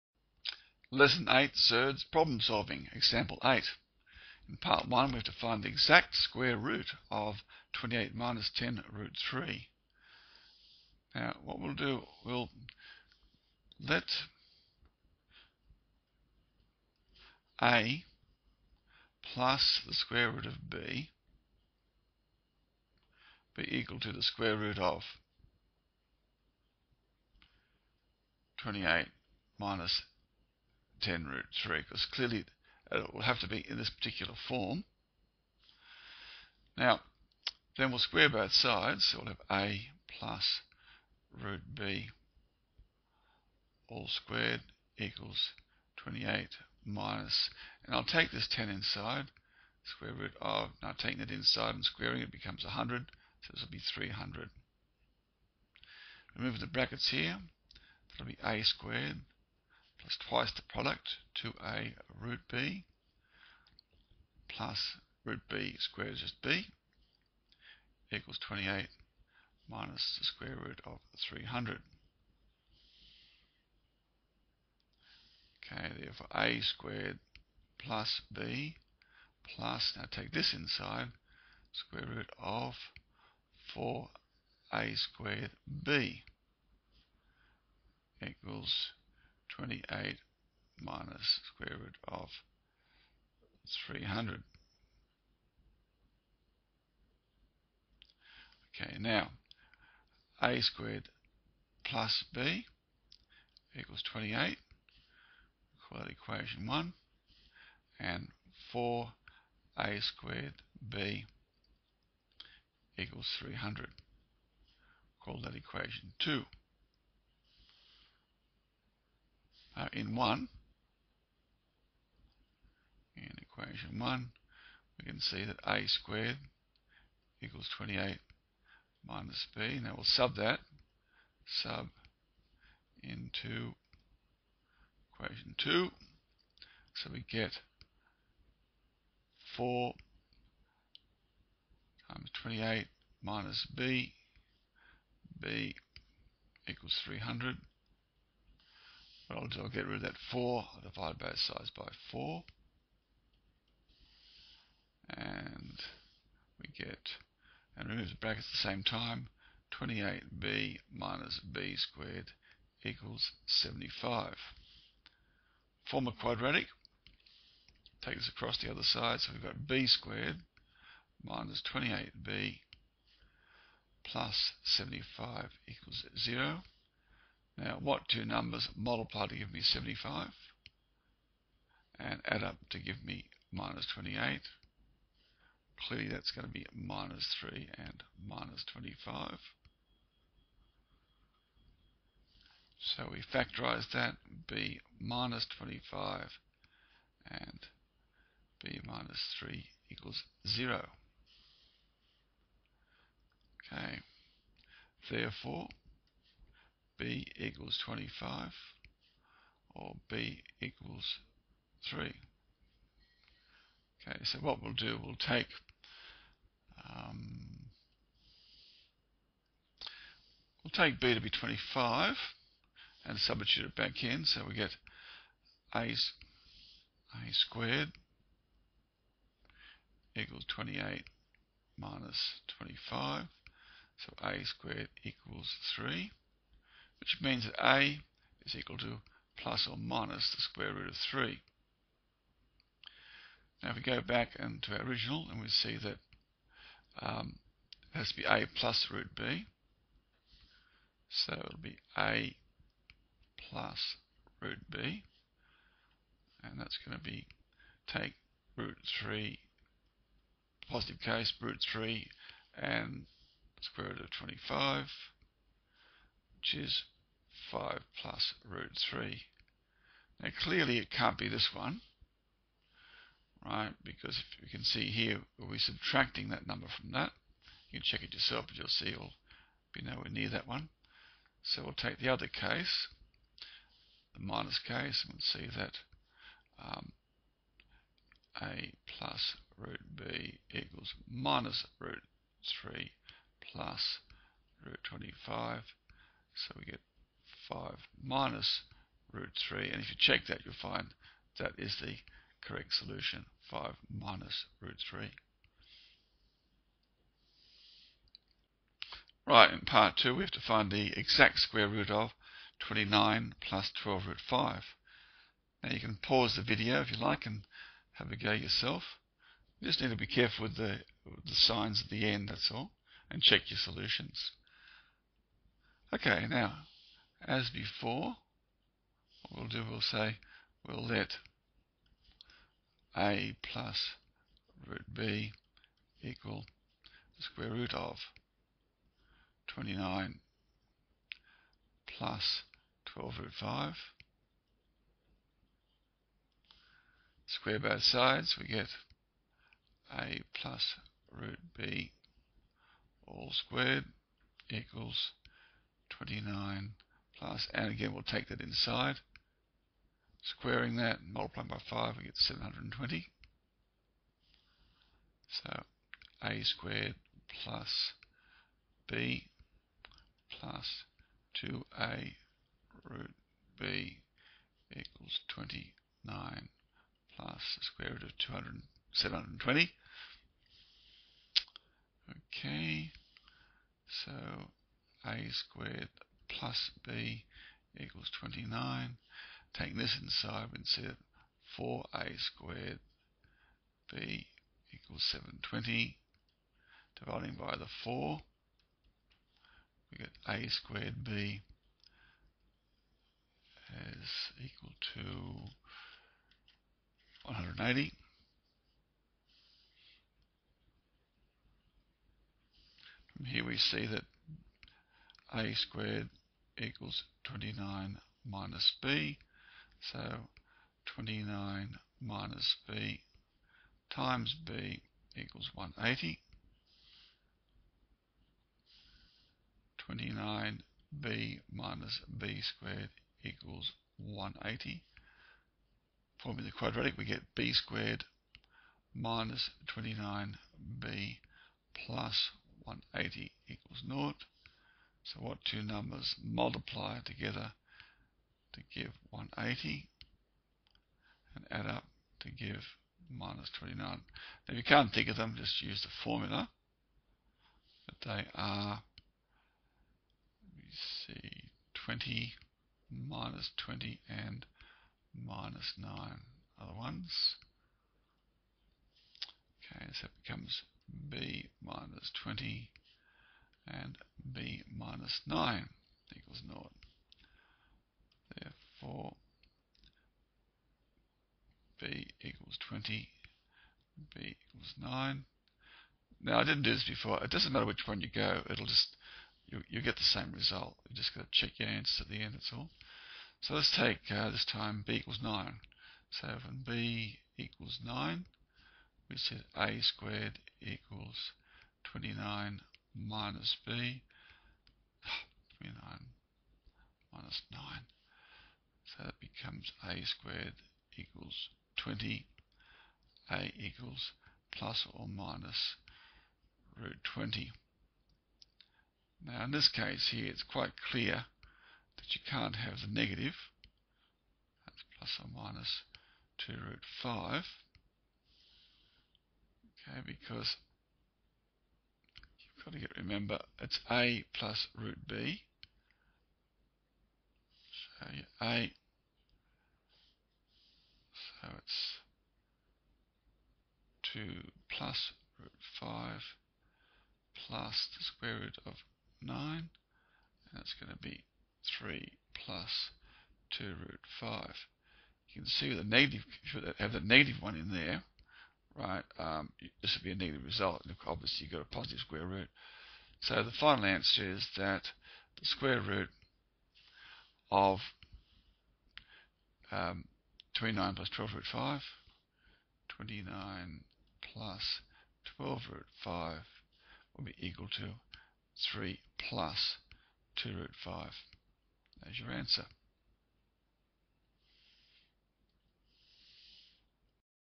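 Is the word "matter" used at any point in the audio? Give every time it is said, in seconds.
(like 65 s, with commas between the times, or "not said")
487 s.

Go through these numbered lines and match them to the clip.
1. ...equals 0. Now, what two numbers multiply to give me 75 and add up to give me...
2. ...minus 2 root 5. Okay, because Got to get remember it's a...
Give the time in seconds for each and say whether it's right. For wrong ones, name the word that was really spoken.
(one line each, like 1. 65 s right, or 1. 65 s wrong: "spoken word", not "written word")
1. 175 s right
2. 525 s right.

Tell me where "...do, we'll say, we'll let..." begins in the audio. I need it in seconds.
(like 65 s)
329 s.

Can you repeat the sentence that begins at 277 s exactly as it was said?
You can check it yourself, but you'll see it'll be nowhere near that one.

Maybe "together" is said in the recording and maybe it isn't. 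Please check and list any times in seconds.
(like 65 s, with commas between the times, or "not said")
446 s.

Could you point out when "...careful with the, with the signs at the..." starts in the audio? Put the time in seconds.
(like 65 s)
320 s.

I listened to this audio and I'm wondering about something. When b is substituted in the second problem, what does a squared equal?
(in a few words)
20.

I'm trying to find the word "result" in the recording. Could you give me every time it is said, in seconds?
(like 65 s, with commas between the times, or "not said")
490 s, 560 s.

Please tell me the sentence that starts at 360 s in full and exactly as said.
Squaring that multiplying by 5, we get 720.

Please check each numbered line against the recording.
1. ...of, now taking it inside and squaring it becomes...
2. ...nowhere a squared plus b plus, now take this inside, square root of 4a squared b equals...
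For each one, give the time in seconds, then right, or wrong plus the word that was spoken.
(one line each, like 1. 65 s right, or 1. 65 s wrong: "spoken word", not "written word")
1. 50 s right
2. 76 s wrong: "therefore", not "nowhere".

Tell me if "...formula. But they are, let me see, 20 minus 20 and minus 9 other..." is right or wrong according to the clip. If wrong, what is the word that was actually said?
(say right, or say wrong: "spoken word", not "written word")
right.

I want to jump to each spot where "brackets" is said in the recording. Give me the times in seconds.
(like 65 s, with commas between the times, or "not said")
56 s, 158 s.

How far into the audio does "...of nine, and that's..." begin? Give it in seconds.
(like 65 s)
548 s.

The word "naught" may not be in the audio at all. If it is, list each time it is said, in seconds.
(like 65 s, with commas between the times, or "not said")
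443 s, 476 s.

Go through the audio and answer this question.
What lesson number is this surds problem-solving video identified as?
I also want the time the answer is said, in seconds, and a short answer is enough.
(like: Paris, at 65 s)
8, at 0 s.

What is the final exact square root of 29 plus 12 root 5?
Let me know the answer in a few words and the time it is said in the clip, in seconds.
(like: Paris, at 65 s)
3 plus 2 root 5, at 578 s.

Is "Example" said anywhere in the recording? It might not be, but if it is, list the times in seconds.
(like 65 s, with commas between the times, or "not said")
2 s.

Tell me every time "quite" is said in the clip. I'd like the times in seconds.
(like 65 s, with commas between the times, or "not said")
520 s.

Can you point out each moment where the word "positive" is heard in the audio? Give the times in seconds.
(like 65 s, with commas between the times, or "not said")
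260 s, 561 s.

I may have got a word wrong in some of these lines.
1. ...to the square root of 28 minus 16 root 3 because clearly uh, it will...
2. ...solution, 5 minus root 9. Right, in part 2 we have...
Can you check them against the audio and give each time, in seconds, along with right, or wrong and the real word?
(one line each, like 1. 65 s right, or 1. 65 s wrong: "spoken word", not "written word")
1. 24 s wrong: "10", not "16"
2. 302 s wrong: "3", not "9".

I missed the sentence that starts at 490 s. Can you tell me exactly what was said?
You just got to check your answers at the end, that's all.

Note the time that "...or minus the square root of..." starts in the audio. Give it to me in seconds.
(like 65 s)
239 s.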